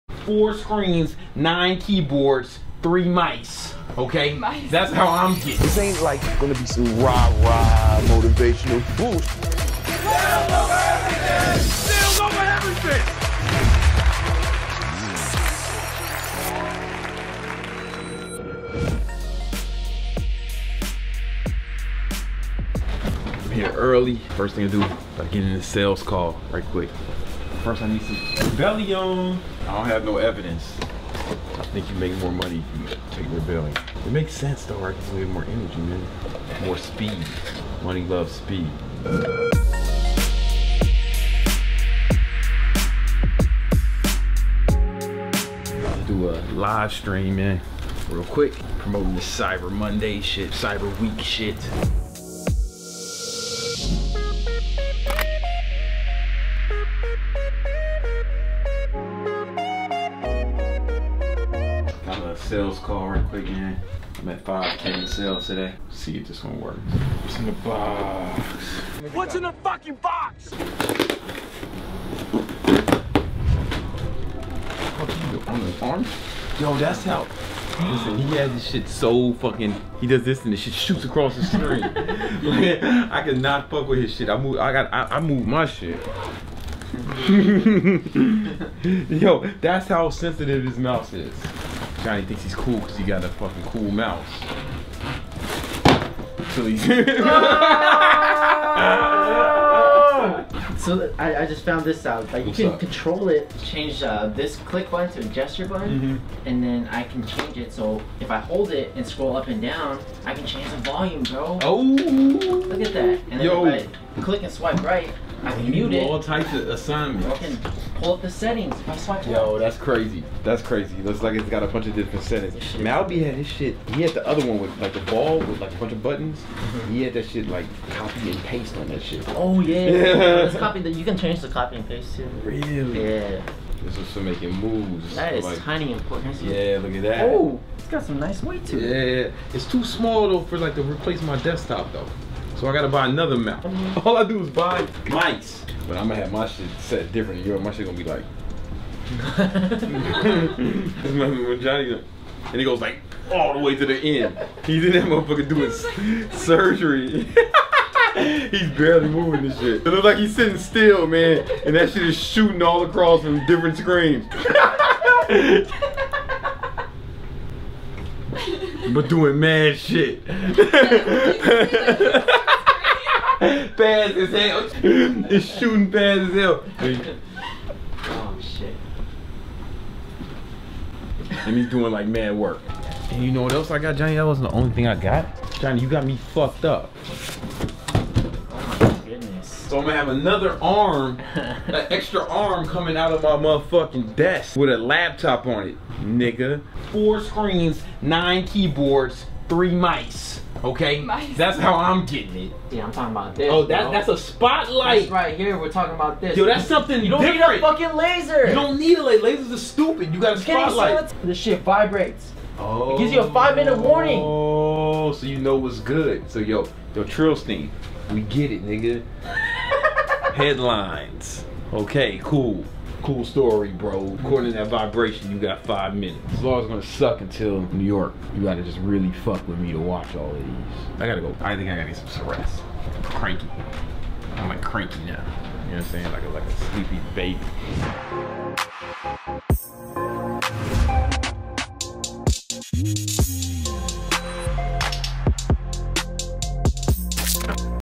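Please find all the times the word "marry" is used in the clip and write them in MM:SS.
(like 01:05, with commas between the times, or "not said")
not said.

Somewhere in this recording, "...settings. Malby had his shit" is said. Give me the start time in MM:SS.
02:02.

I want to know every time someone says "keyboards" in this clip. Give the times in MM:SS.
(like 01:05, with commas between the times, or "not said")
00:01, 03:18.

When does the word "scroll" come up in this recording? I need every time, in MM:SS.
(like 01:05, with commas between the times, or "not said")
01:49.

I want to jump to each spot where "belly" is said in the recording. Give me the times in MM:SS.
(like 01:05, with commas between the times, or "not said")
00:28, 00:33.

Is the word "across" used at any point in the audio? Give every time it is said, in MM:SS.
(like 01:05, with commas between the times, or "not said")
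01:21, 02:42.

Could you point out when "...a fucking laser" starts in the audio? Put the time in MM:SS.
03:27.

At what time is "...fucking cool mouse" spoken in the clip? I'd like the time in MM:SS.
01:33.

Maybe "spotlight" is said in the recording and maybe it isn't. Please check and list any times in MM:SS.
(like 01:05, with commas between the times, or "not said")
03:24, 03:30.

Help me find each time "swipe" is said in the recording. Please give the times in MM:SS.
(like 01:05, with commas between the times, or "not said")
01:54, 01:58.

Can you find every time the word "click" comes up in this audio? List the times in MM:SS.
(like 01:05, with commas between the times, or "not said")
01:44, 01:54.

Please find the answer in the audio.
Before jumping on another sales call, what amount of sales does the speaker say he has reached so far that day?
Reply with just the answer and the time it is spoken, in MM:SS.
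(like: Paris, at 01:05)
5K, at 01:04.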